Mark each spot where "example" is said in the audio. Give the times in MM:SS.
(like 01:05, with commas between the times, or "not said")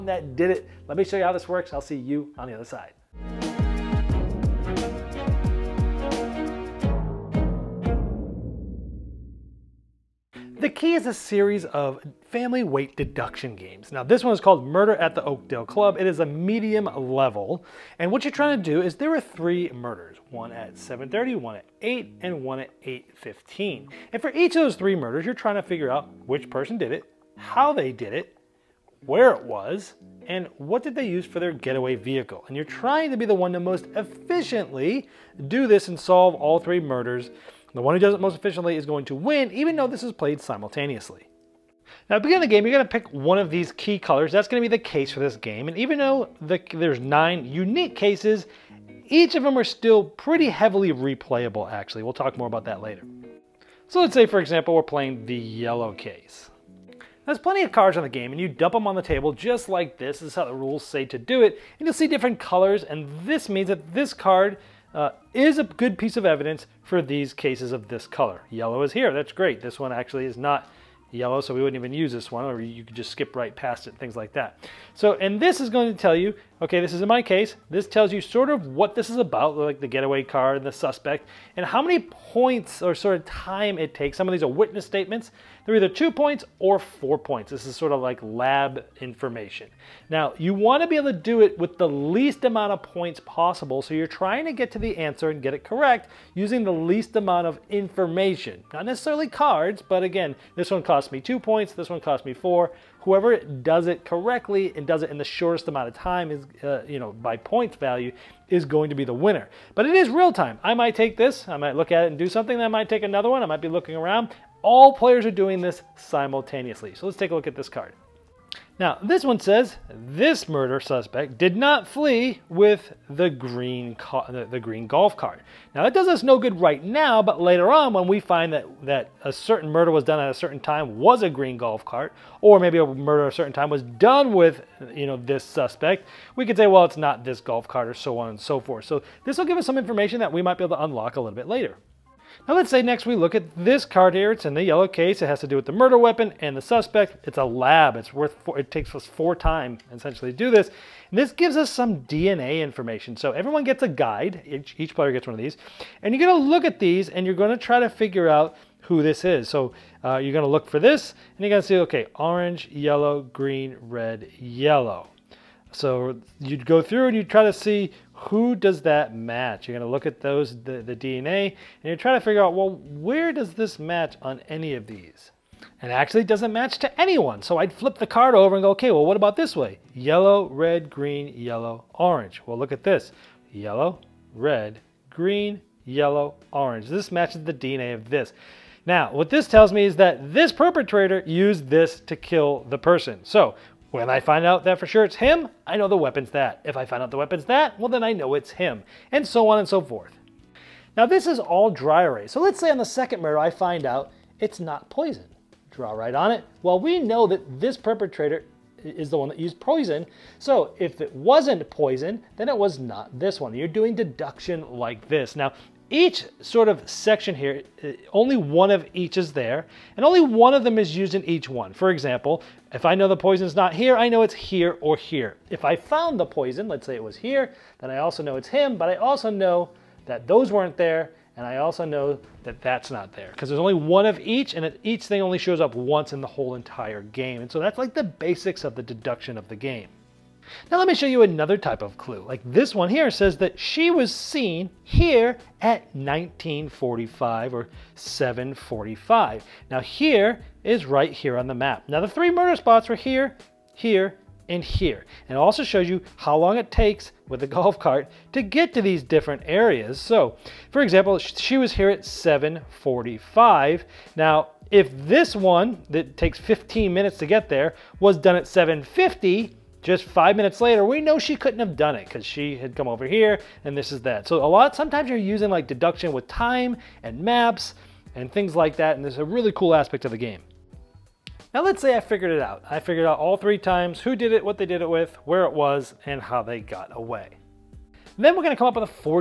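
00:54, 03:41, 04:20.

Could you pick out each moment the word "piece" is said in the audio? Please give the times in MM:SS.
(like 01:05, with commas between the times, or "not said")
01:05.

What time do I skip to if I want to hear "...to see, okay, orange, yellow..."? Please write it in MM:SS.
02:41.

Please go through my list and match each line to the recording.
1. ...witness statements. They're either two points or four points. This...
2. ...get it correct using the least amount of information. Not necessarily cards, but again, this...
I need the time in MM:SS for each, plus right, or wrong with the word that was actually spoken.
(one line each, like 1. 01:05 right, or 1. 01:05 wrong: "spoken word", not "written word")
1. 01:24 right
2. 01:35 right.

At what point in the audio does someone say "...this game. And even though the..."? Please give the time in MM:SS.
00:45.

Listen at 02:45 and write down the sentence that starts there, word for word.
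So you'd go through and you try to see who does that match.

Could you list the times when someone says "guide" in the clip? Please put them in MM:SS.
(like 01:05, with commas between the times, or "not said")
02:33.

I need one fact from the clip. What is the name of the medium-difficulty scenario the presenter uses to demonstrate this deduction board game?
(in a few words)
Murder at the Oakdale Club.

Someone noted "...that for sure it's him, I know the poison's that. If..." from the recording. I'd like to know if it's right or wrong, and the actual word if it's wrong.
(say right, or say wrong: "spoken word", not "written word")
wrong: "weapon", not "poison".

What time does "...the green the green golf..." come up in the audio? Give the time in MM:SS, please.
02:03.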